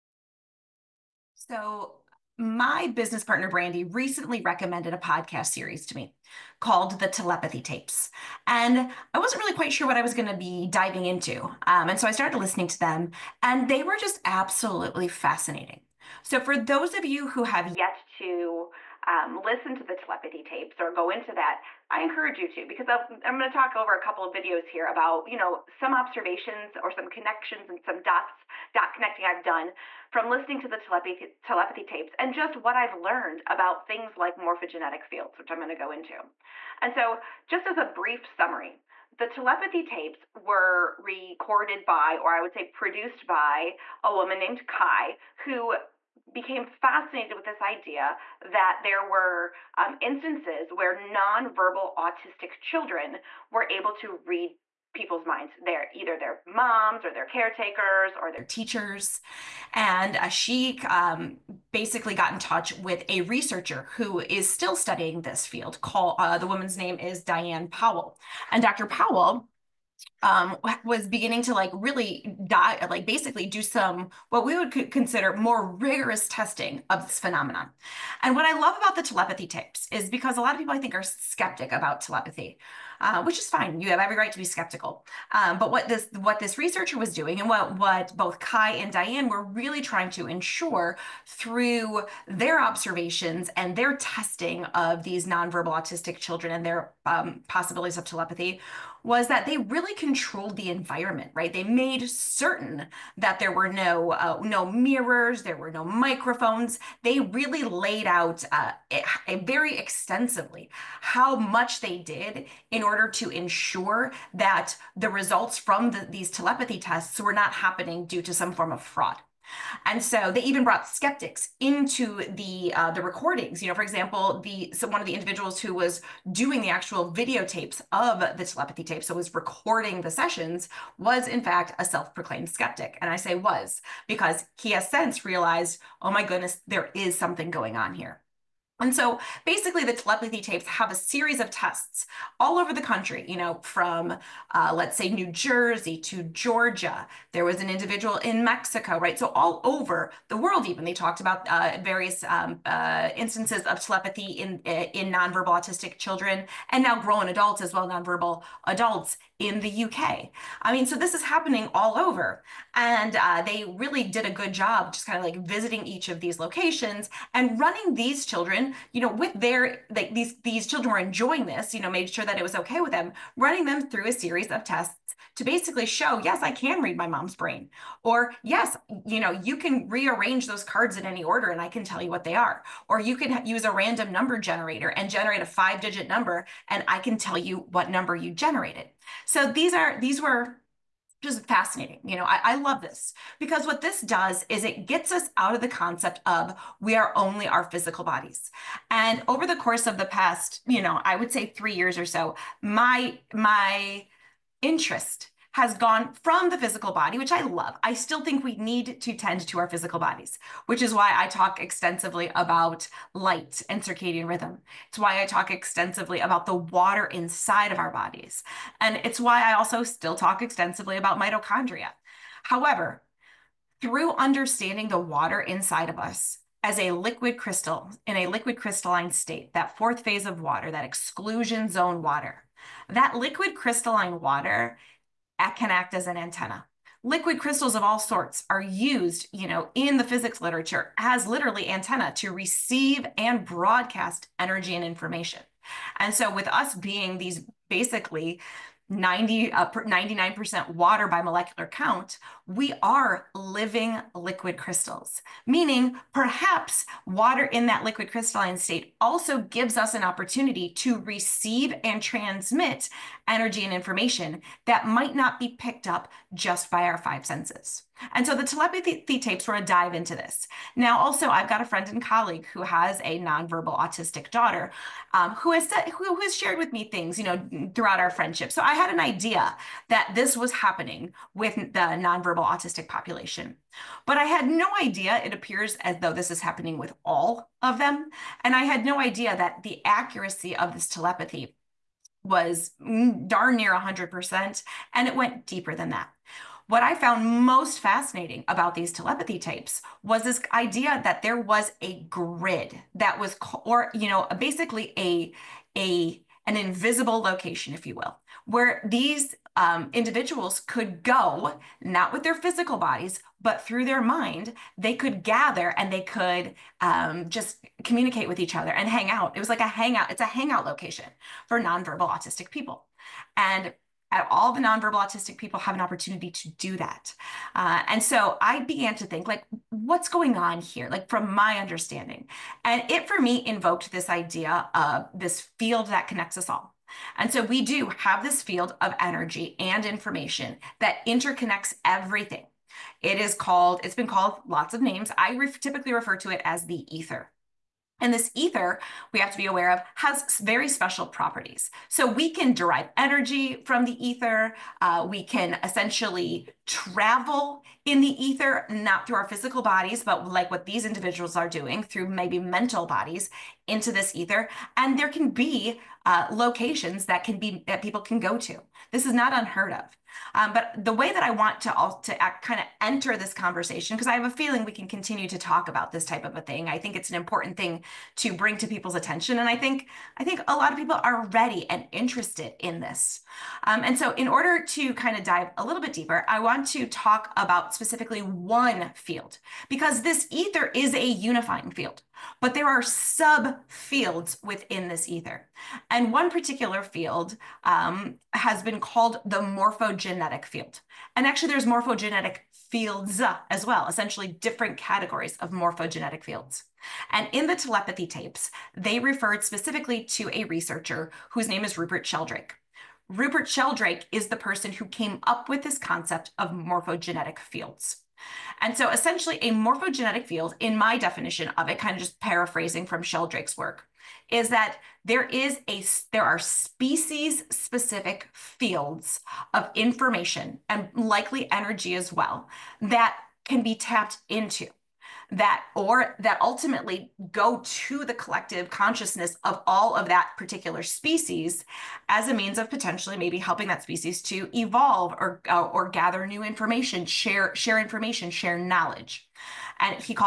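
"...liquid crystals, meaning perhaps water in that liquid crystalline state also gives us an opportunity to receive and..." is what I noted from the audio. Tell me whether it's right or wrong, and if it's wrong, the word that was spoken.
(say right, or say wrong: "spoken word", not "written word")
right.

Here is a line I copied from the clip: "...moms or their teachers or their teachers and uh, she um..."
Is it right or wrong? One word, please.
wrong.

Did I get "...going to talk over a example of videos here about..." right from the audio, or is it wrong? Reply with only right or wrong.
wrong.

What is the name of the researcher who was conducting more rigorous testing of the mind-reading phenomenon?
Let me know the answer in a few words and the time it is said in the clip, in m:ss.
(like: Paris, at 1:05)
Diane Powell, at 1:07.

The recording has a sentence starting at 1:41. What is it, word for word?
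They made certain that there were no uh, no mirrors, there were no microphones.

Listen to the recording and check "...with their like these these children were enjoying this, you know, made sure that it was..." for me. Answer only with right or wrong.
right.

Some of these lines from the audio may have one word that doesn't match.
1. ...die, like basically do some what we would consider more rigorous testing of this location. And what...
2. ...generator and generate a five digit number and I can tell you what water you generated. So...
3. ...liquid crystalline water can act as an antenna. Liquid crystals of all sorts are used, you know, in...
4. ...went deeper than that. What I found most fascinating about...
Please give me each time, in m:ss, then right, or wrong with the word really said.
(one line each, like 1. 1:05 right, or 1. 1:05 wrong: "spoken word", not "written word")
1. 1:12 wrong: "phenomenon", not "location"
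2. 3:04 wrong: "number", not "water"
3. 3:53 right
4. 4:55 right.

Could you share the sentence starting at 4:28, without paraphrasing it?
And so the telepathy tapes were a dive into this.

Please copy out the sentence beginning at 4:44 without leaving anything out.
But I had no idea, it appears as though this is happening with all of them.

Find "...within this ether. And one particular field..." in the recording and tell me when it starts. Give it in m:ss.
6:34.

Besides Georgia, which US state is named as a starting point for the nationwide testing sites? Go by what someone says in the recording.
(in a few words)
New Jersey.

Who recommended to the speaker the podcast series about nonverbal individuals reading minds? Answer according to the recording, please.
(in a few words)
Brandy.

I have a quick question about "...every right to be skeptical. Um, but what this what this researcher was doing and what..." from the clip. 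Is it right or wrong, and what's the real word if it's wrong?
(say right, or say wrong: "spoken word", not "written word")
right.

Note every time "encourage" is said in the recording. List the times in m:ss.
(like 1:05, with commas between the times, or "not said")
0:22.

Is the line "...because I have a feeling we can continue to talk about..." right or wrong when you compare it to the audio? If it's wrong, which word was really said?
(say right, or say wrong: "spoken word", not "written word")
right.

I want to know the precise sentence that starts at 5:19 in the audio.
It was like a hangout, it's a hangout location for nonverbal autistic people.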